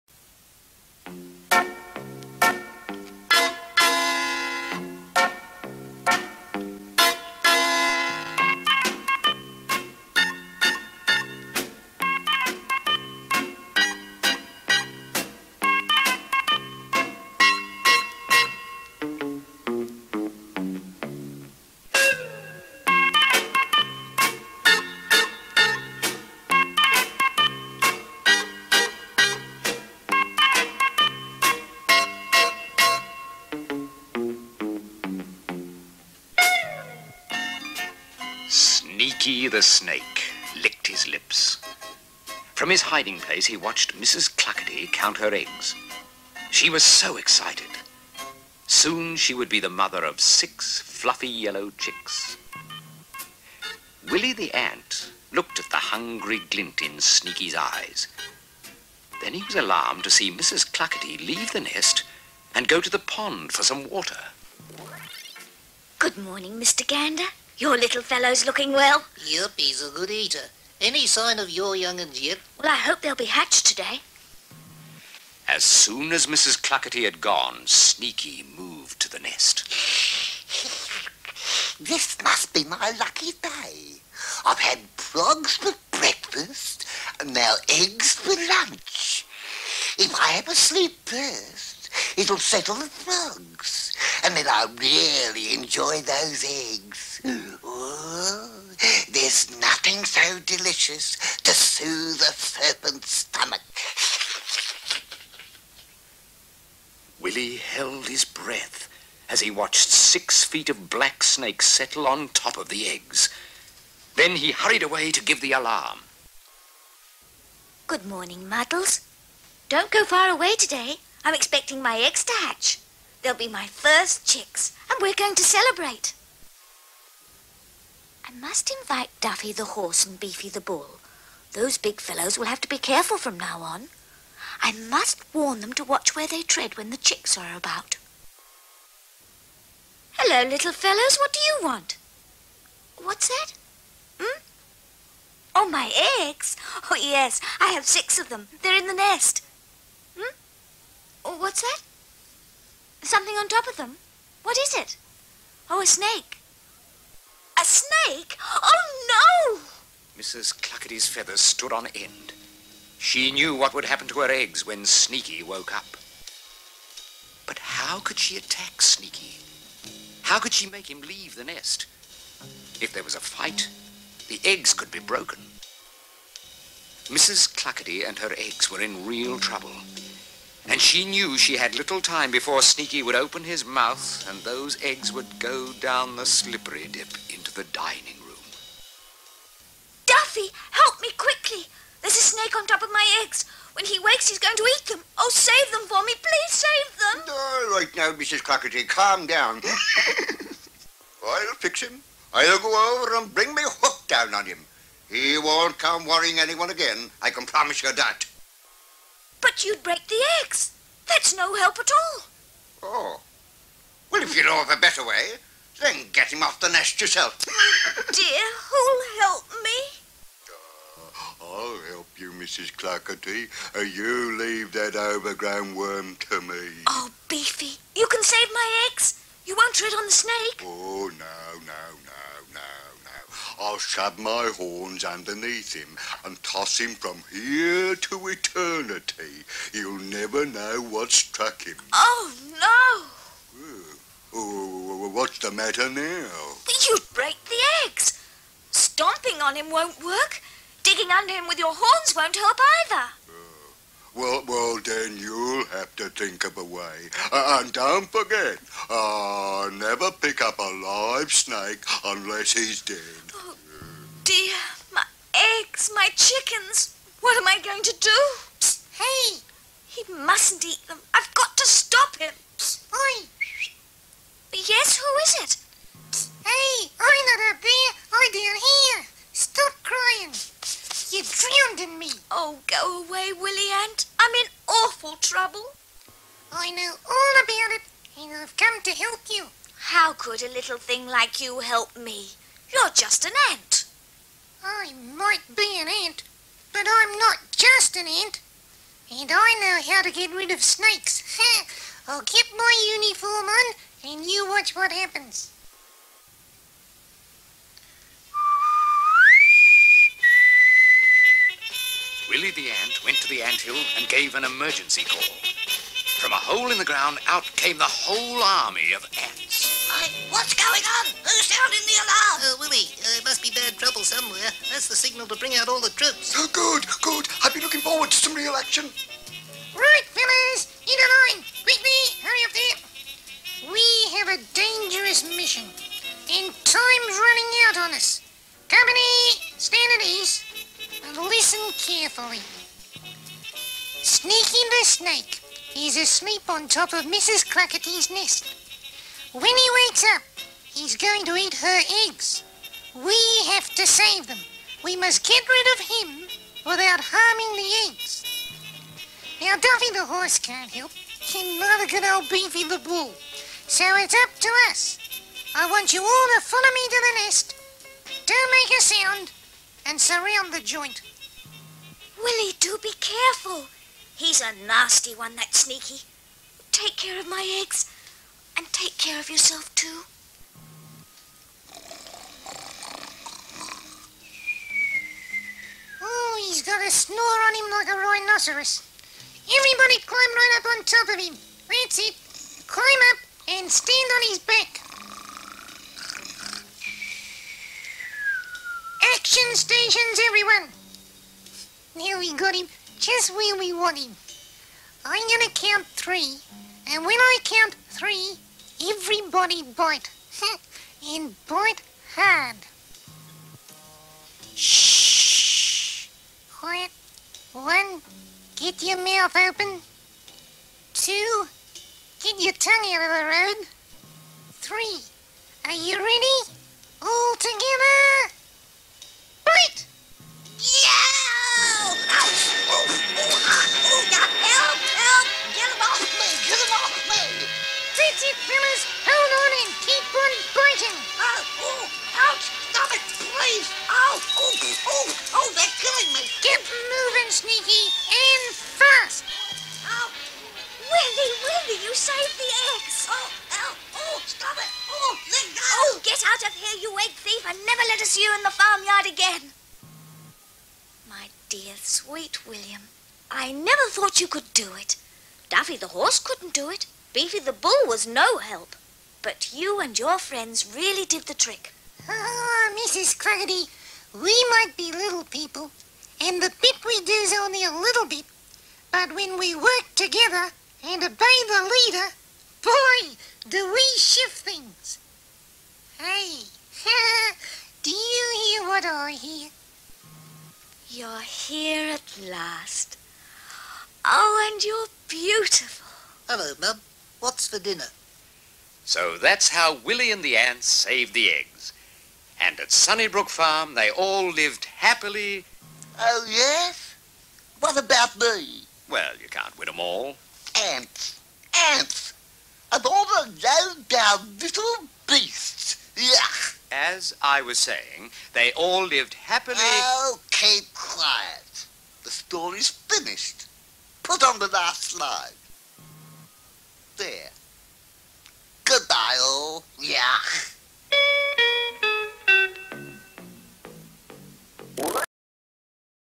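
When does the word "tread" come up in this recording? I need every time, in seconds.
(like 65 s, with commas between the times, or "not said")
136 s, 229 s.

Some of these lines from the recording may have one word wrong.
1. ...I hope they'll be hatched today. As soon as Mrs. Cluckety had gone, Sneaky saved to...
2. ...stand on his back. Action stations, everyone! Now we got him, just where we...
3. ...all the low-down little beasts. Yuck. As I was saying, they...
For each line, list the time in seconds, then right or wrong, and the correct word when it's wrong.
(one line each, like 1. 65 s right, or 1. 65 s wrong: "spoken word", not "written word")
1. 72 s wrong: "moved", not "saved"
2. 393 s right
3. 512 s right.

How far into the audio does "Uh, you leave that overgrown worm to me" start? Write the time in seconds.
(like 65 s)
223 s.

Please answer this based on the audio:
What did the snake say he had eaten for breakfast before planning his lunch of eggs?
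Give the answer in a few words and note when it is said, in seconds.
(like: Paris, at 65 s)
Frogs, at 84 s.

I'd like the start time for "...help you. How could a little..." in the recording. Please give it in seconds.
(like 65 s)
288 s.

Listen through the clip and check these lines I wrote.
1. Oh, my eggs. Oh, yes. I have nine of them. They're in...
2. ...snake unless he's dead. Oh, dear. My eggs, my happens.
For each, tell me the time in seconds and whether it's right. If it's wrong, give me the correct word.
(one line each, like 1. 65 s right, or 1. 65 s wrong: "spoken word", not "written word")
1. 145 s wrong: "six", not "nine"
2. 261 s wrong: "chickens", not "happens".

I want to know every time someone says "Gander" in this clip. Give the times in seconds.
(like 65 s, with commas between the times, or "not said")
66 s.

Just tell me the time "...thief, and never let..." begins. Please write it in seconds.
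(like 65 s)
457 s.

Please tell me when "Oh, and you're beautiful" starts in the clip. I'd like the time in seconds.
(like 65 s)
494 s.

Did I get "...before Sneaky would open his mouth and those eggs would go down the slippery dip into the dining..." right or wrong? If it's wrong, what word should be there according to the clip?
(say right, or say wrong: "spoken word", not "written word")
right.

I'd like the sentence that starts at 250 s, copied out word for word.
Digging under him with your horns won't help either.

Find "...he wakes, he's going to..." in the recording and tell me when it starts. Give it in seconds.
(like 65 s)
193 s.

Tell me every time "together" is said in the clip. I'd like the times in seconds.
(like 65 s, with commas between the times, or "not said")
427 s, 479 s.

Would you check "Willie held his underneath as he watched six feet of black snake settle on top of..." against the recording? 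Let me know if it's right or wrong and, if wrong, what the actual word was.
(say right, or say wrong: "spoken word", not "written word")
wrong: "breath", not "underneath".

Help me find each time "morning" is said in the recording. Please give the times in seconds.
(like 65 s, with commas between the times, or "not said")
66 s, 118 s.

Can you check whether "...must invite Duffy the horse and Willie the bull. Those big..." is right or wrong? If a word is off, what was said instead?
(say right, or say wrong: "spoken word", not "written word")
wrong: "Beefy", not "Willie".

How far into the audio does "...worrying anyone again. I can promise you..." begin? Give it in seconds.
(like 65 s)
206 s.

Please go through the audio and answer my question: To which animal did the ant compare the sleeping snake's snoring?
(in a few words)
Rhinoceros.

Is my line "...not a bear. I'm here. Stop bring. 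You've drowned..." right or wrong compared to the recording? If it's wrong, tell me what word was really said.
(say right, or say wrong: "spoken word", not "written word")
wrong: "crying", not "bring".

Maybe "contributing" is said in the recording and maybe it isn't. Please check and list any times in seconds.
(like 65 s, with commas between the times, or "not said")
not said.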